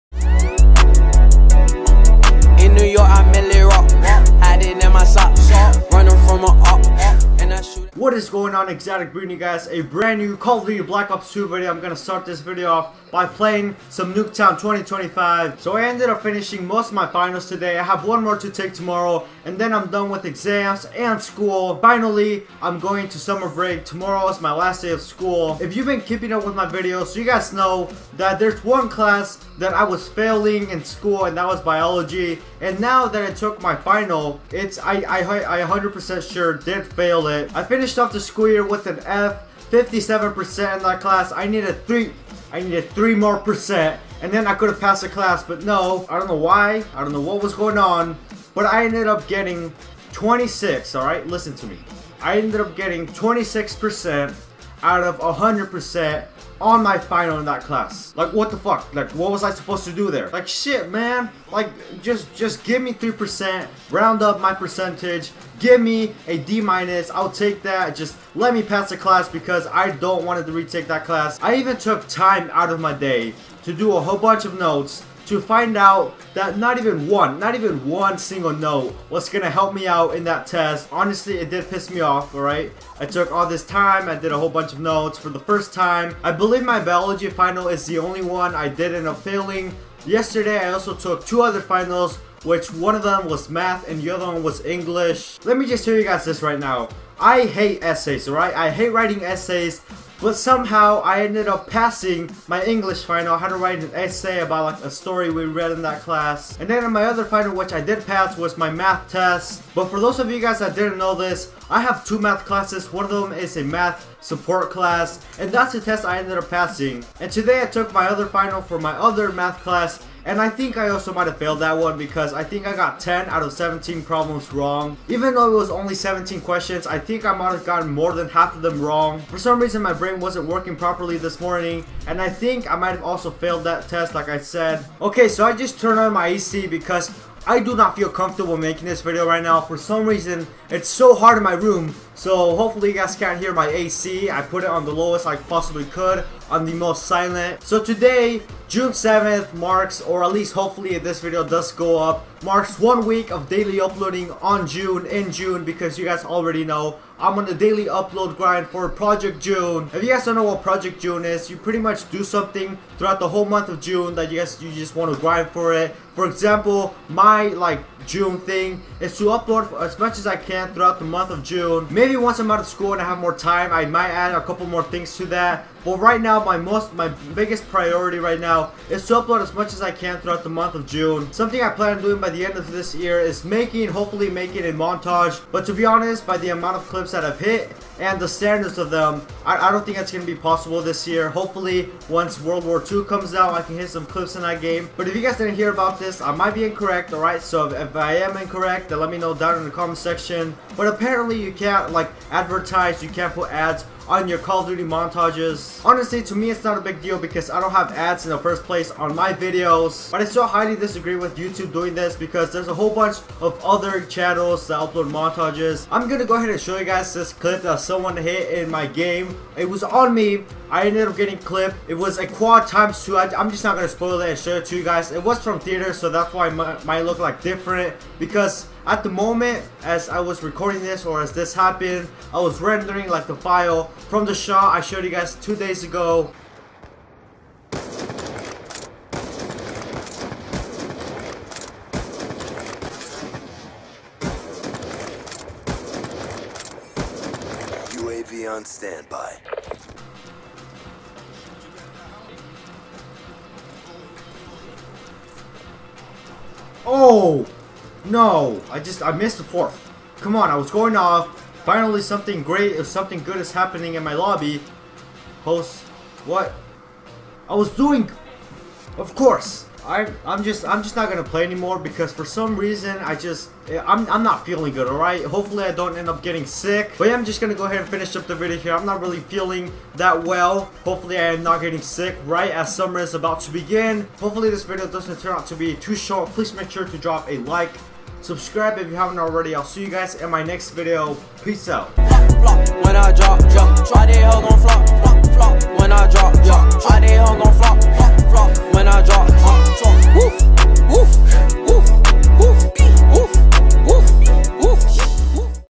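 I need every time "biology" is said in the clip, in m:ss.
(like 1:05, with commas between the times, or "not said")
0:31, 1:26.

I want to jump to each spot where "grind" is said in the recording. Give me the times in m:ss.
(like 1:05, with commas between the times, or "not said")
2:38, 2:45.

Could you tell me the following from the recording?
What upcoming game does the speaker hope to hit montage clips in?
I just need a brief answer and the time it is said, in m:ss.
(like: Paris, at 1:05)
World War II, at 3:12.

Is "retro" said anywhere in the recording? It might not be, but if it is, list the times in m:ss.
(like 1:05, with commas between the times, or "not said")
not said.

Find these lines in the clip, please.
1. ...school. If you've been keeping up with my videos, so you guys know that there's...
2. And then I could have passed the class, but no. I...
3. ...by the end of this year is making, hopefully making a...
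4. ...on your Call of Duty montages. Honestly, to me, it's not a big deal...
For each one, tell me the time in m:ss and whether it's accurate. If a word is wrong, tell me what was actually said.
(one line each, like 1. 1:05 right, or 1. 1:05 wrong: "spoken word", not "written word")
1. 0:25 right
2. 0:44 right
3. 3:02 right
4. 3:24 right.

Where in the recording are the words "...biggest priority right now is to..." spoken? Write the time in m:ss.
2:57.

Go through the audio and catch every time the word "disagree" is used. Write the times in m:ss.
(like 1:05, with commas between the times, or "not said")
3:30.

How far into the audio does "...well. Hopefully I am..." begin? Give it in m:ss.
4:40.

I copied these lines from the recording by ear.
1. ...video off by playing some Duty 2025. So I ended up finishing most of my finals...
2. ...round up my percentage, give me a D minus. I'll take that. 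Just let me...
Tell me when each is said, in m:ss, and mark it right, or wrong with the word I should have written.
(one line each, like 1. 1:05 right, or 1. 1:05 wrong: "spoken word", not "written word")
1. 0:12 wrong: "Nuketown", not "Duty"
2. 1:03 right.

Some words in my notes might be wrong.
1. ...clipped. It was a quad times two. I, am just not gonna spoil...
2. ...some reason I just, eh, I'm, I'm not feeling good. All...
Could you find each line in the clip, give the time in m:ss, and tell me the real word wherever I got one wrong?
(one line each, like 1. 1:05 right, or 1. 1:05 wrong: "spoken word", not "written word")
1. 3:41 right
2. 4:32 right.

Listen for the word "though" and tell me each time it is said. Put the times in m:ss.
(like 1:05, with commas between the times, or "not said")
2:05.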